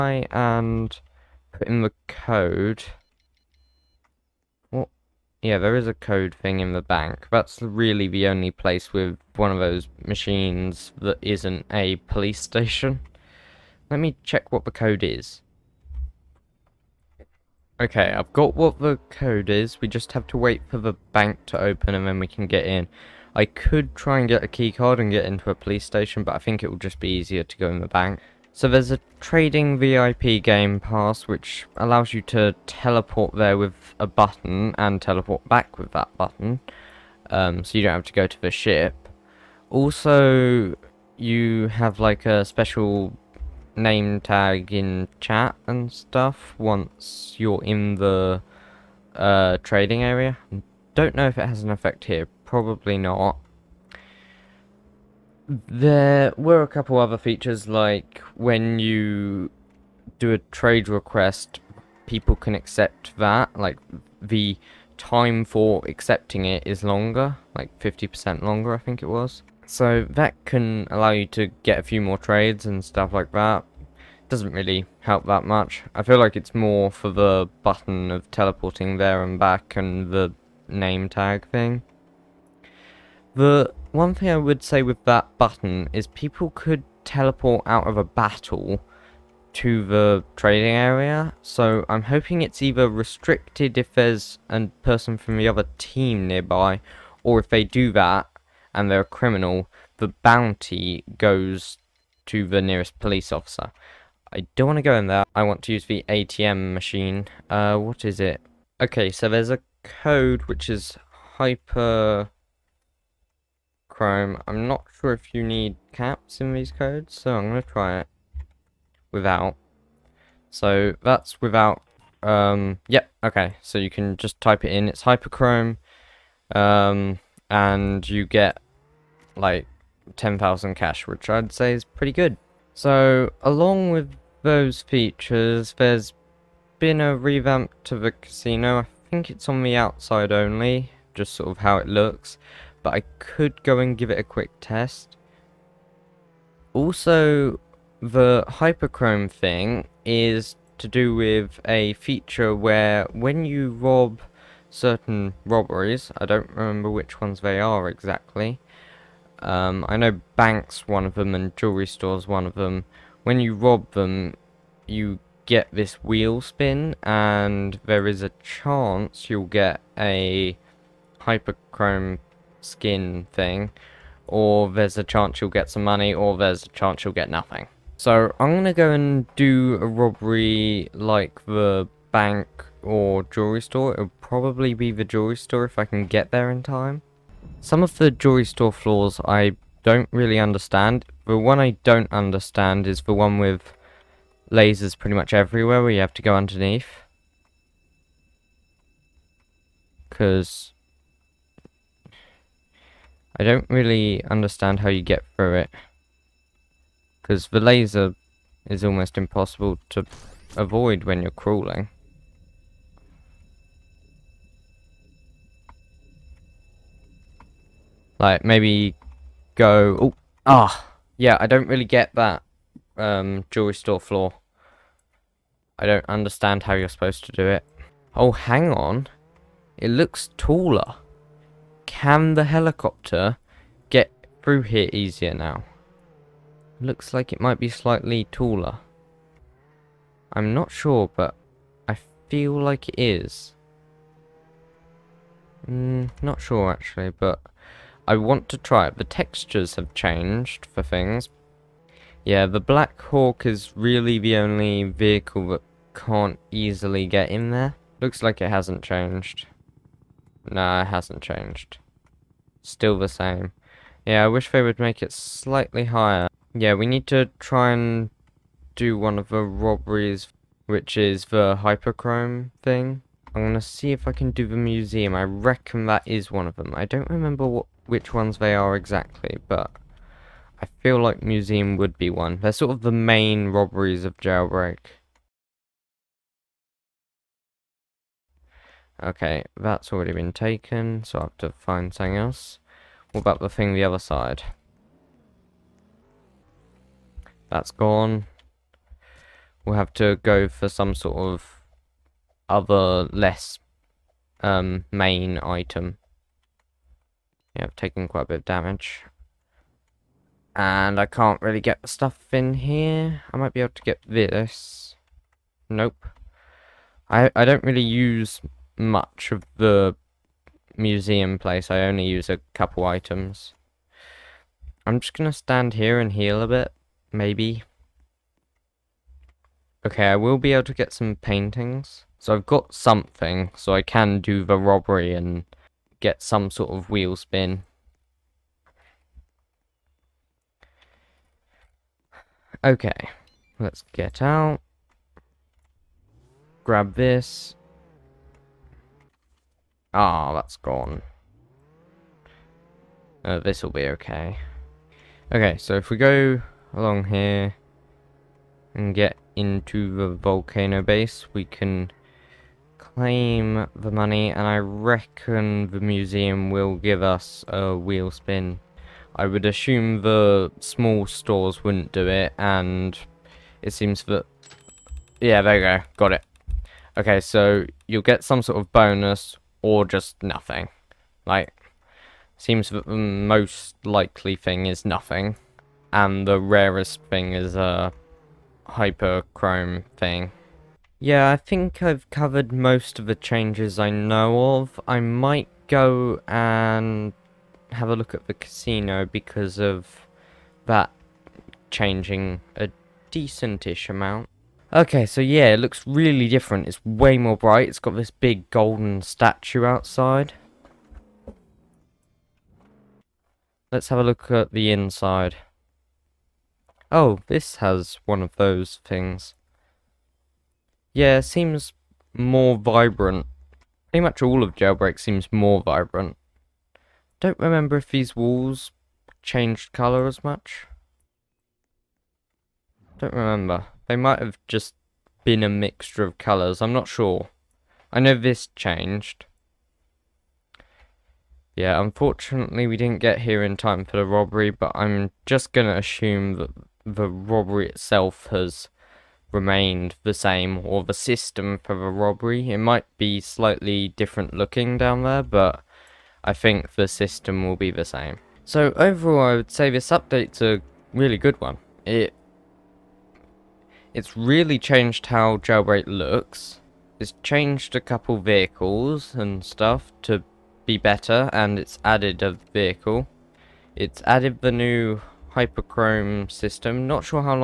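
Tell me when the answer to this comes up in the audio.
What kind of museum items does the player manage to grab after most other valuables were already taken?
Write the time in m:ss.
5:31.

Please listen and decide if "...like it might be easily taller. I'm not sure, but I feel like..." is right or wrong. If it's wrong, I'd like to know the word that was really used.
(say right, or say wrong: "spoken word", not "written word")
wrong: "slightly", not "easily".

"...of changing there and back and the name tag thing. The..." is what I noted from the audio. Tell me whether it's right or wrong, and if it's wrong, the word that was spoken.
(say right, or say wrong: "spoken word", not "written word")
wrong: "teleporting", not "changing".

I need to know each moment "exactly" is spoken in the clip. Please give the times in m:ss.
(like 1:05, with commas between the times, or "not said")
2:37, 4:38.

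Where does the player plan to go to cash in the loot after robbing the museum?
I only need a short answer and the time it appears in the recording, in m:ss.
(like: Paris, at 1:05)
Volcano base, at 6:00.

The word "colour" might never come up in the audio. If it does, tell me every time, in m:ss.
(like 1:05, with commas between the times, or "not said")
7:09, 7:16.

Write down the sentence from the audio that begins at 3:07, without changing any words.
Some of the jewelry store floors I don't really understand.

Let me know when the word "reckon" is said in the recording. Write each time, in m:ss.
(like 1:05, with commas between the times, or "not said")
4:35, 6:04.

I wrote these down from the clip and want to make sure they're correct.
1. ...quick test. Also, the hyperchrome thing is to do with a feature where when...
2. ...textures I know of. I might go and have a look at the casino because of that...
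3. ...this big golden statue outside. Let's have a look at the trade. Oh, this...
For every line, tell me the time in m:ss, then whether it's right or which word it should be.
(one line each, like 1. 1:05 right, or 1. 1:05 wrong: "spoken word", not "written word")
1. 2:24 right
2. 6:33 wrong: "changes", not "textures"
3. 6:47 wrong: "inside", not "trade".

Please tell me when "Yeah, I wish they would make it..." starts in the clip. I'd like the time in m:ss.
4:24.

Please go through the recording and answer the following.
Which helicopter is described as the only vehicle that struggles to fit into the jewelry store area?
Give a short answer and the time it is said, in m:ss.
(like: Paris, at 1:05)
Black Hawk, at 4:12.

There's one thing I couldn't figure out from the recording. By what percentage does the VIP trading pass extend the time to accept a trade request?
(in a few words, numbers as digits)
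50%.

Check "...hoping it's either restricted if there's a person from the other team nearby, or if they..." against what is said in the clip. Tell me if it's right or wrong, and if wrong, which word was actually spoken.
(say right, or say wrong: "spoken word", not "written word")
right.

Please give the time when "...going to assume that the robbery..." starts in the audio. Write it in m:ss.
7:25.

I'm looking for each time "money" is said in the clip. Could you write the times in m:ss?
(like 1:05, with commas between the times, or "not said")
2:55, 6:03.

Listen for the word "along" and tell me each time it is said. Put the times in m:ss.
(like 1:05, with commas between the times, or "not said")
2:13, 5:56.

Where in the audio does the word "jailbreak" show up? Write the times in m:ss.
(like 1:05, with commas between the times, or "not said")
4:44, 7:04, 7:45.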